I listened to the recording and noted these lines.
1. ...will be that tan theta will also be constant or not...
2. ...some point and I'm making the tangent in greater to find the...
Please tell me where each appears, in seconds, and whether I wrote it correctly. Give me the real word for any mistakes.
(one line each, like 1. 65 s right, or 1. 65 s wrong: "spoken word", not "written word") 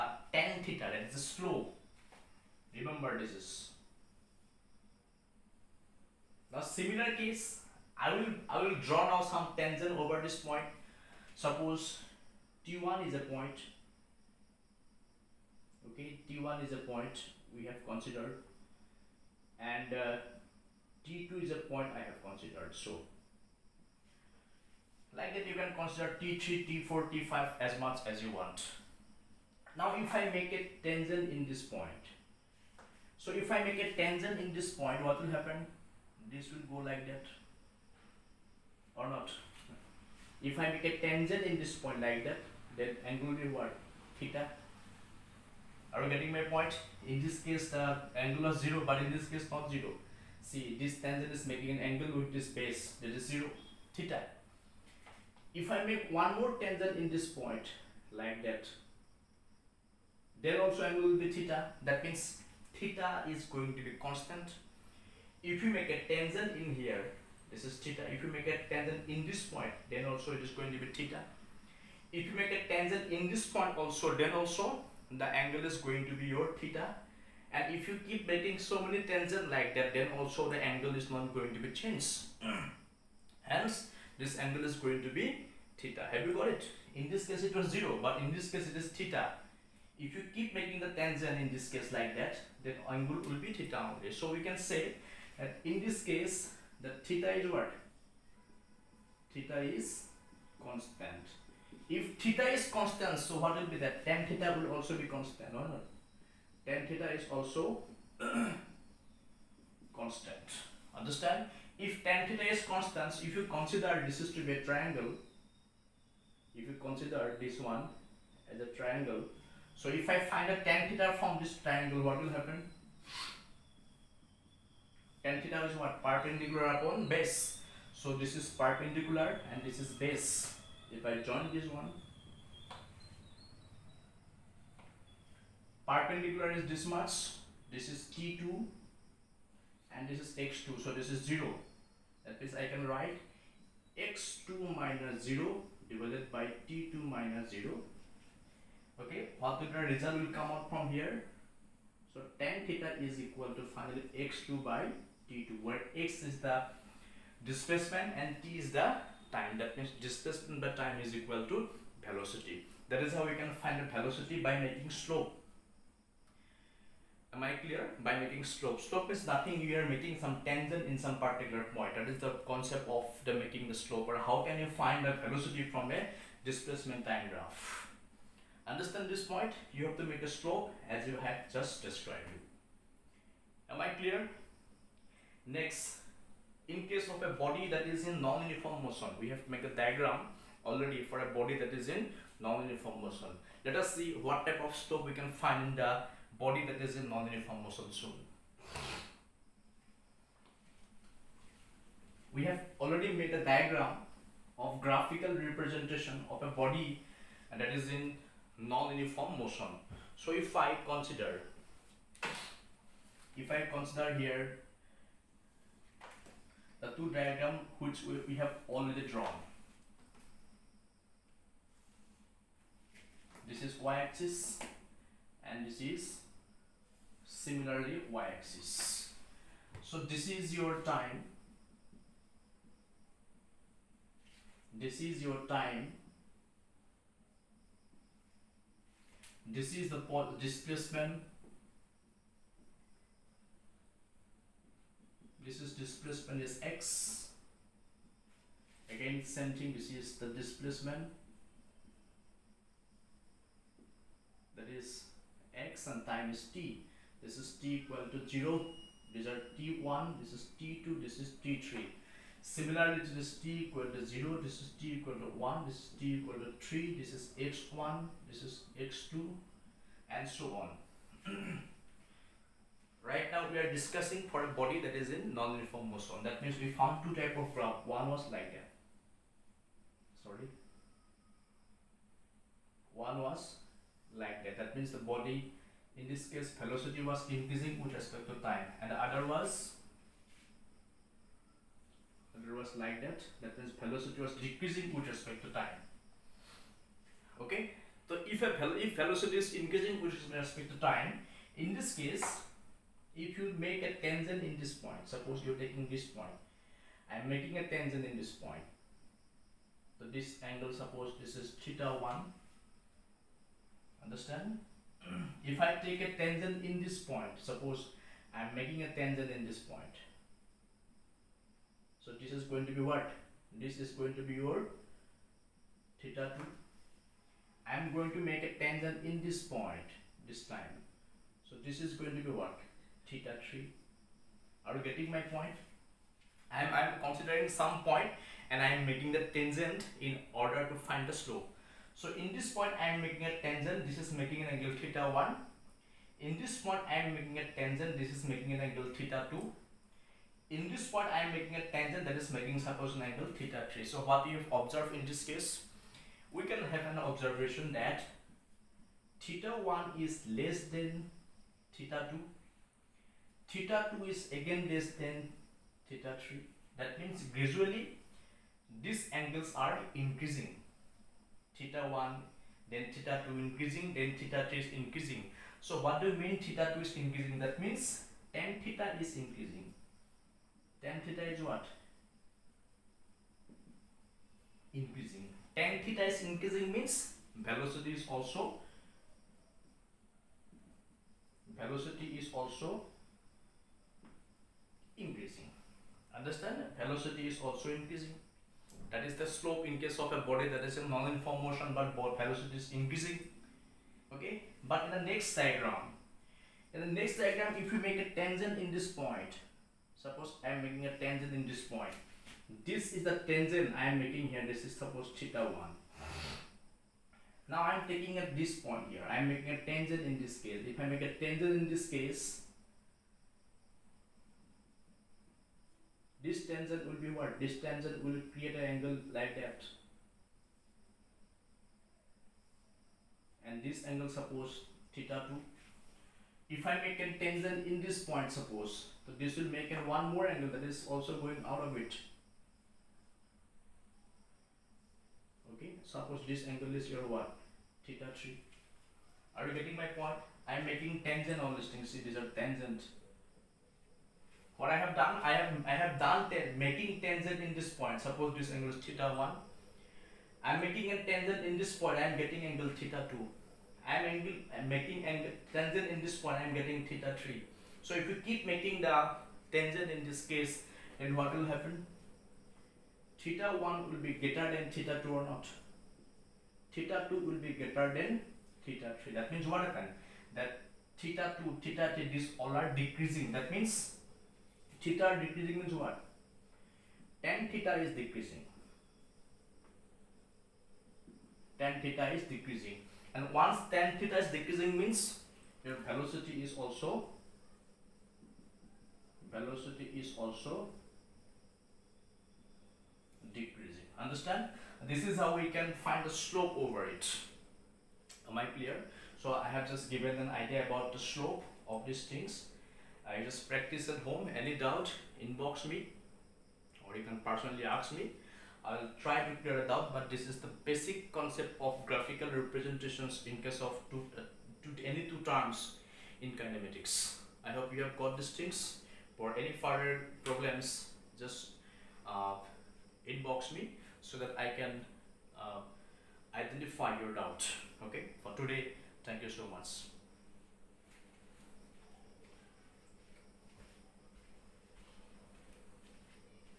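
1. 103 s right
2. 337 s wrong: "order", not "greater".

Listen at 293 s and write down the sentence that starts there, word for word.
That means velocity was decreasing with respect to time.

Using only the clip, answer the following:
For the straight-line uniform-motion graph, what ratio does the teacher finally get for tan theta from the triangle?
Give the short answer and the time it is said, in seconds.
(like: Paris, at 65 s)
x2 by t2, at 154 s.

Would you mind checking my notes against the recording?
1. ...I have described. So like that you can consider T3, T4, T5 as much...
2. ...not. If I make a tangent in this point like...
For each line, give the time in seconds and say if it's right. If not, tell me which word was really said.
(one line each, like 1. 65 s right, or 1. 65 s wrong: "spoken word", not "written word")
1. 21 s wrong: "considered", not "described"
2. 39 s right.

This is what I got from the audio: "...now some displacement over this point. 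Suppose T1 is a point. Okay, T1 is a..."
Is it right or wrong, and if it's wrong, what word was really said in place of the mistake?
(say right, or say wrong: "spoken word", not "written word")
wrong: "tangent", not "displacement".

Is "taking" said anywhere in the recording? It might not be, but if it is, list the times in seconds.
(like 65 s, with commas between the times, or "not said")
305 s, 417 s.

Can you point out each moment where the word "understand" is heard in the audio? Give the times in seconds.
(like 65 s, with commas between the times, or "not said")
110 s, 178 s, 314 s, 396 s, 503 s.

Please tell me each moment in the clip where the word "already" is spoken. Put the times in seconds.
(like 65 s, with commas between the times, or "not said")
190 s, 202 s, 218 s.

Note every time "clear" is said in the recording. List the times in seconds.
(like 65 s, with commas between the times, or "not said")
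167 s, 183 s, 508 s, 519 s.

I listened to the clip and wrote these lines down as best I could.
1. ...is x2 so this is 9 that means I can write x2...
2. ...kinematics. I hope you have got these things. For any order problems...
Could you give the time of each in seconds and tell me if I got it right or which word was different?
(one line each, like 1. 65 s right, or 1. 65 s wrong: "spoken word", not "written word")
1. 140 s wrong: "0", not "9"
2. 526 s wrong: "further", not "order".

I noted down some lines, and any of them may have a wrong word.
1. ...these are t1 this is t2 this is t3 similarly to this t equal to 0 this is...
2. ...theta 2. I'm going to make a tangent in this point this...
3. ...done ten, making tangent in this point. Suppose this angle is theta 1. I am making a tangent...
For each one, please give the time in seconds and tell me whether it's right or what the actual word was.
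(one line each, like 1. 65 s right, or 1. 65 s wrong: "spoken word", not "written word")
1. 259 s right
2. 326 s right
3. 455 s right.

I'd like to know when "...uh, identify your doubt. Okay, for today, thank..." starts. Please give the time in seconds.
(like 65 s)
535 s.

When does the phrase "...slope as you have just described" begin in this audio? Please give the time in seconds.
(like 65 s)
180 s.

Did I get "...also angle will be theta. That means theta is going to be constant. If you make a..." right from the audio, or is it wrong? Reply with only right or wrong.
right.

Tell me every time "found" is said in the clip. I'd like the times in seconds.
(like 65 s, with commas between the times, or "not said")
276 s.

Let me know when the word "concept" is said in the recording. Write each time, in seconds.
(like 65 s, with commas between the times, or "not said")
172 s, 521 s.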